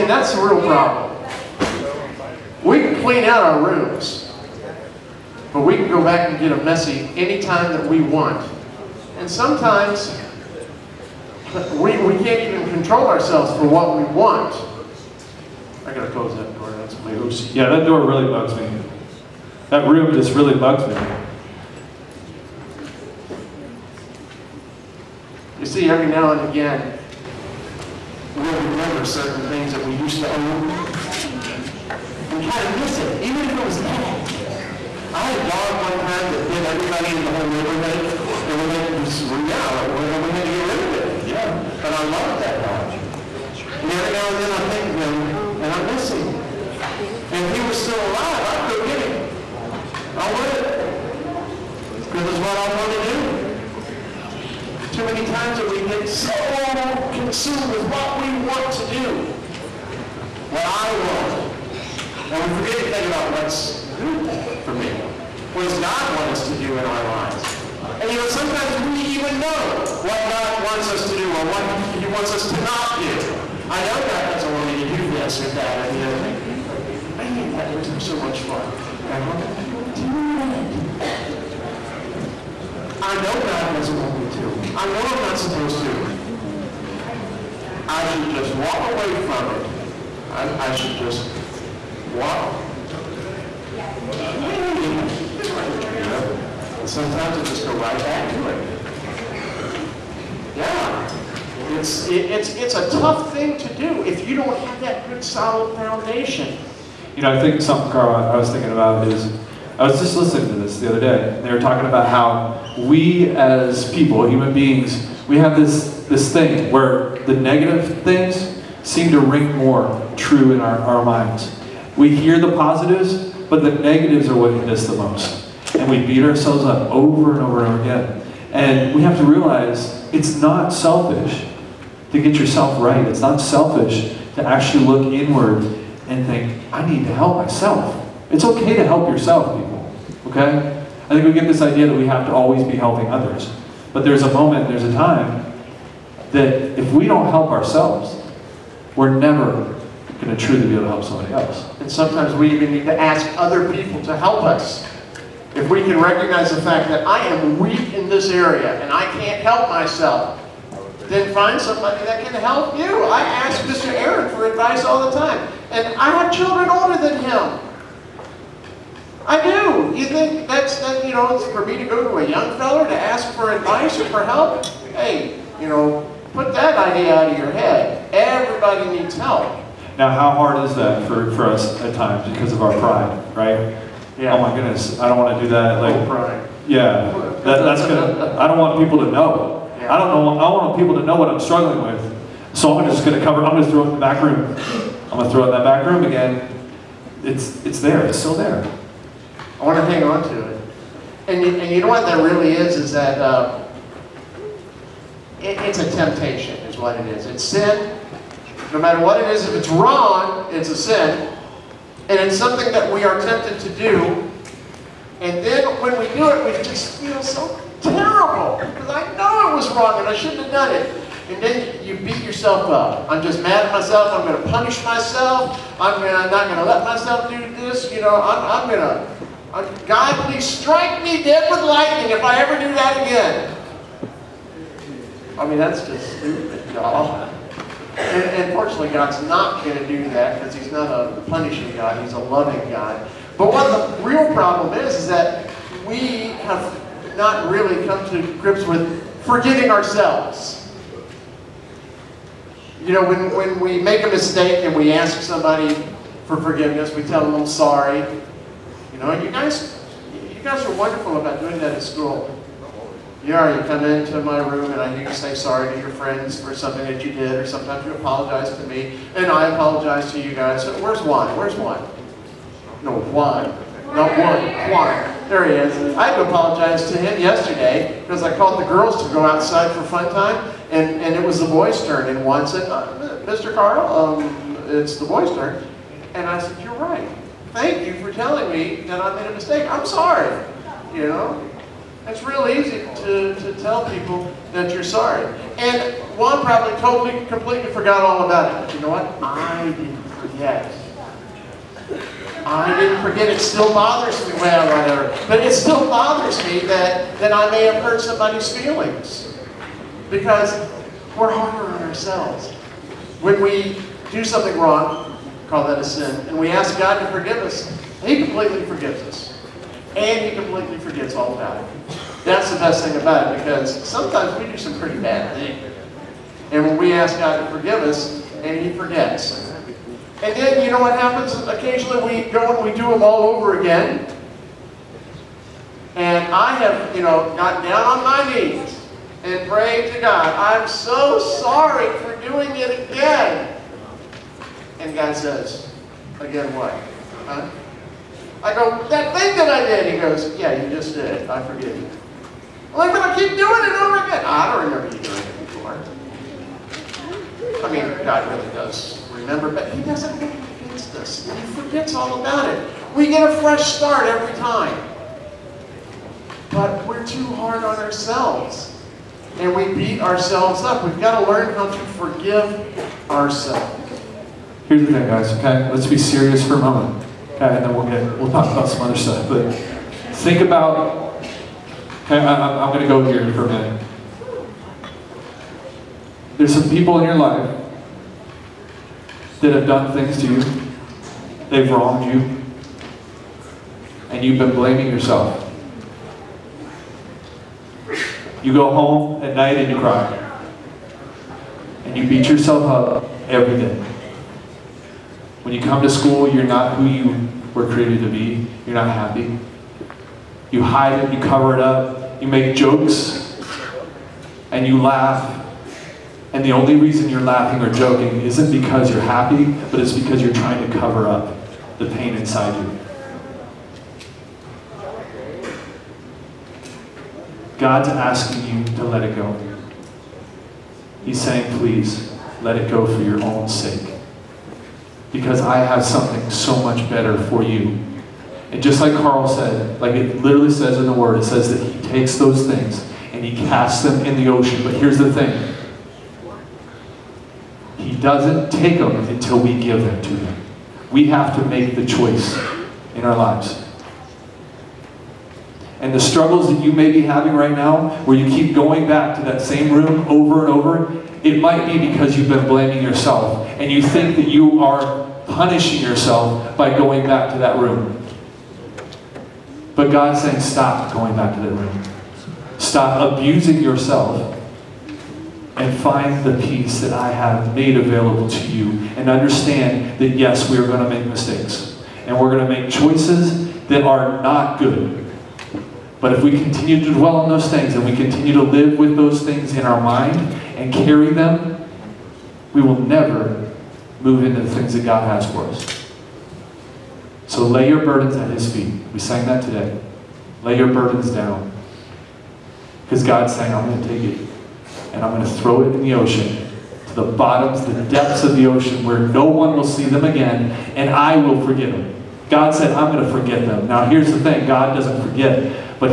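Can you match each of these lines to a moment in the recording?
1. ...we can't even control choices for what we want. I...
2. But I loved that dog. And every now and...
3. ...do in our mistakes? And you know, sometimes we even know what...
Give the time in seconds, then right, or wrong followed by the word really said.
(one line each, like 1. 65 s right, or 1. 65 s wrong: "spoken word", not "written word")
1. 12 s wrong: "ourselves", not "choices"
2. 41 s right
3. 66 s wrong: "lives", not "mistakes".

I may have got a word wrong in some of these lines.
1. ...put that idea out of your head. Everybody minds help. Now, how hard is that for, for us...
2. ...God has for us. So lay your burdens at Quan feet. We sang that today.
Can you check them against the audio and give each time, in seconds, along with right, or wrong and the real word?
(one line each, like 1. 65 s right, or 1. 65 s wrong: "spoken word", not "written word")
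1. 176 s wrong: "needs", not "minds"
2. 494 s wrong: "His", not "Quan".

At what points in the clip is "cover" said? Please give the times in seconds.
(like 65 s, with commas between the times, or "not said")
193 s, 411 s, 420 s.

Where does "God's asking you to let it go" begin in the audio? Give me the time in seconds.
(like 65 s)
427 s.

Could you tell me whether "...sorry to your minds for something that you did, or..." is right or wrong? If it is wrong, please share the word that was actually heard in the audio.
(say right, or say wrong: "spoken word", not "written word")
wrong: "friends", not "minds".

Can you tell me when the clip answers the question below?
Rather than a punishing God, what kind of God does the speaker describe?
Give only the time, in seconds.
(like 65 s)
242 s.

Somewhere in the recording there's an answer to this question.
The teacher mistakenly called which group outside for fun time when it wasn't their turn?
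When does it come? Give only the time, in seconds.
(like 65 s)
278 s.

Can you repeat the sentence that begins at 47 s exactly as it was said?
And if he was still alive, I'd go get him.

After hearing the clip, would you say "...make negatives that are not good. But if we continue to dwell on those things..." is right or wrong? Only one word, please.
wrong.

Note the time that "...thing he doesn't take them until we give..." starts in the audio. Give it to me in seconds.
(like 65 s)
445 s.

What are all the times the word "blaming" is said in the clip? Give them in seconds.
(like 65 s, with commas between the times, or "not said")
394 s, 462 s.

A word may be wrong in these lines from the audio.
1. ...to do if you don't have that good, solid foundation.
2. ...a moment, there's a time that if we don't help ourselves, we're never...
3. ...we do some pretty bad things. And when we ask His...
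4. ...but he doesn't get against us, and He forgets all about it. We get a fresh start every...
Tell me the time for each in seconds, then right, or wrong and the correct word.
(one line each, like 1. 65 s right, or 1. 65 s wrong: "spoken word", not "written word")
1. 103 s right
2. 144 s right
3. 324 s wrong: "God", not "His"
4. 359 s right.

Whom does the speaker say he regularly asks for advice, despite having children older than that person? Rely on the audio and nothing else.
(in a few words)
Mr. Aaron.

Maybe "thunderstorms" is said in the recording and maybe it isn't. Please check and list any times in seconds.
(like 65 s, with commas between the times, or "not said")
not said.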